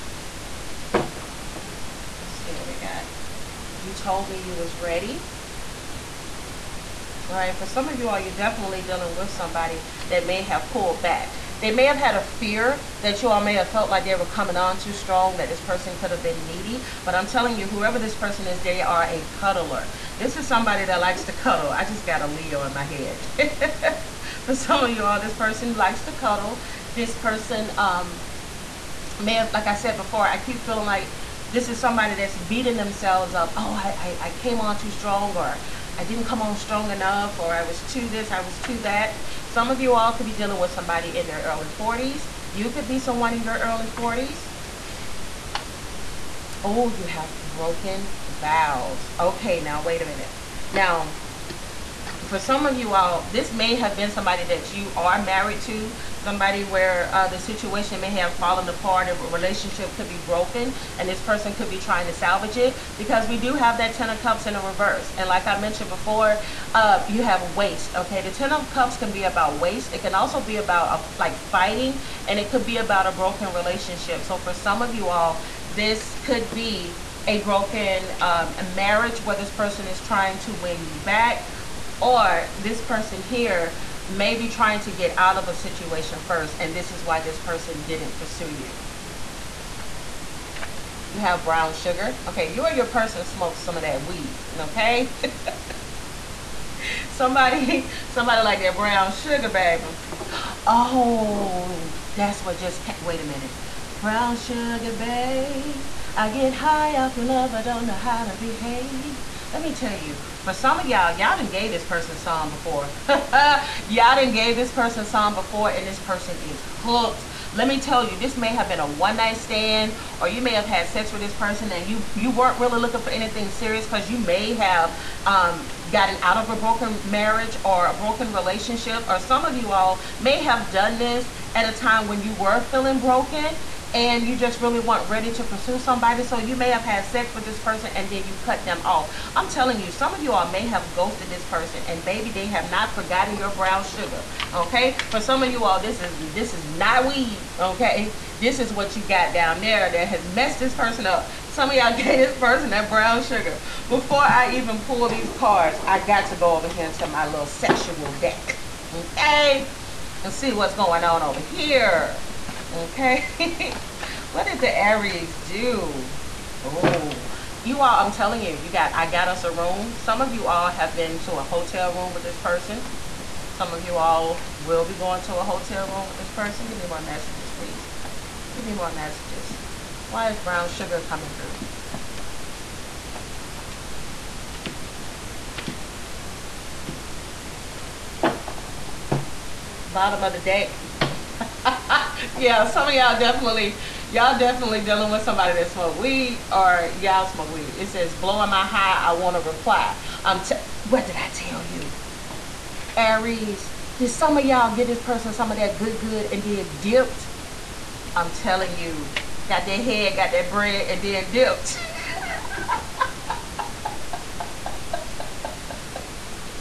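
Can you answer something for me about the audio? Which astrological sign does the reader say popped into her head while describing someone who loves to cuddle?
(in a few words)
Leo.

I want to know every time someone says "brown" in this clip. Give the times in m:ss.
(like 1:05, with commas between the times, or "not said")
1:31, 1:38, 1:44, 2:23, 2:32, 3:00.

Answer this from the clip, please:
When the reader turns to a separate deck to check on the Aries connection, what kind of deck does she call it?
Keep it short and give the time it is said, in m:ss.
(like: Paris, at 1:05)
sexual deck, at 2:37.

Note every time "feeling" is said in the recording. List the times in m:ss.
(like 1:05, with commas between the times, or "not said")
0:30, 2:12.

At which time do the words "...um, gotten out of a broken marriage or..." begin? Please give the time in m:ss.
2:05.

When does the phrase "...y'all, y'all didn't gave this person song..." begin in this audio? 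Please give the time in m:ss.
1:50.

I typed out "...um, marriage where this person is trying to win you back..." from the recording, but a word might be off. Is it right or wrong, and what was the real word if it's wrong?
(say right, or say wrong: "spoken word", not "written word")
right.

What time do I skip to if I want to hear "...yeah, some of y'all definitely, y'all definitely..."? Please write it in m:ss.
3:12.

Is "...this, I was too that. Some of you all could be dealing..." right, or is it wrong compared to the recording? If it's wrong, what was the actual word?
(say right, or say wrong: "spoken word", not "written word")
right.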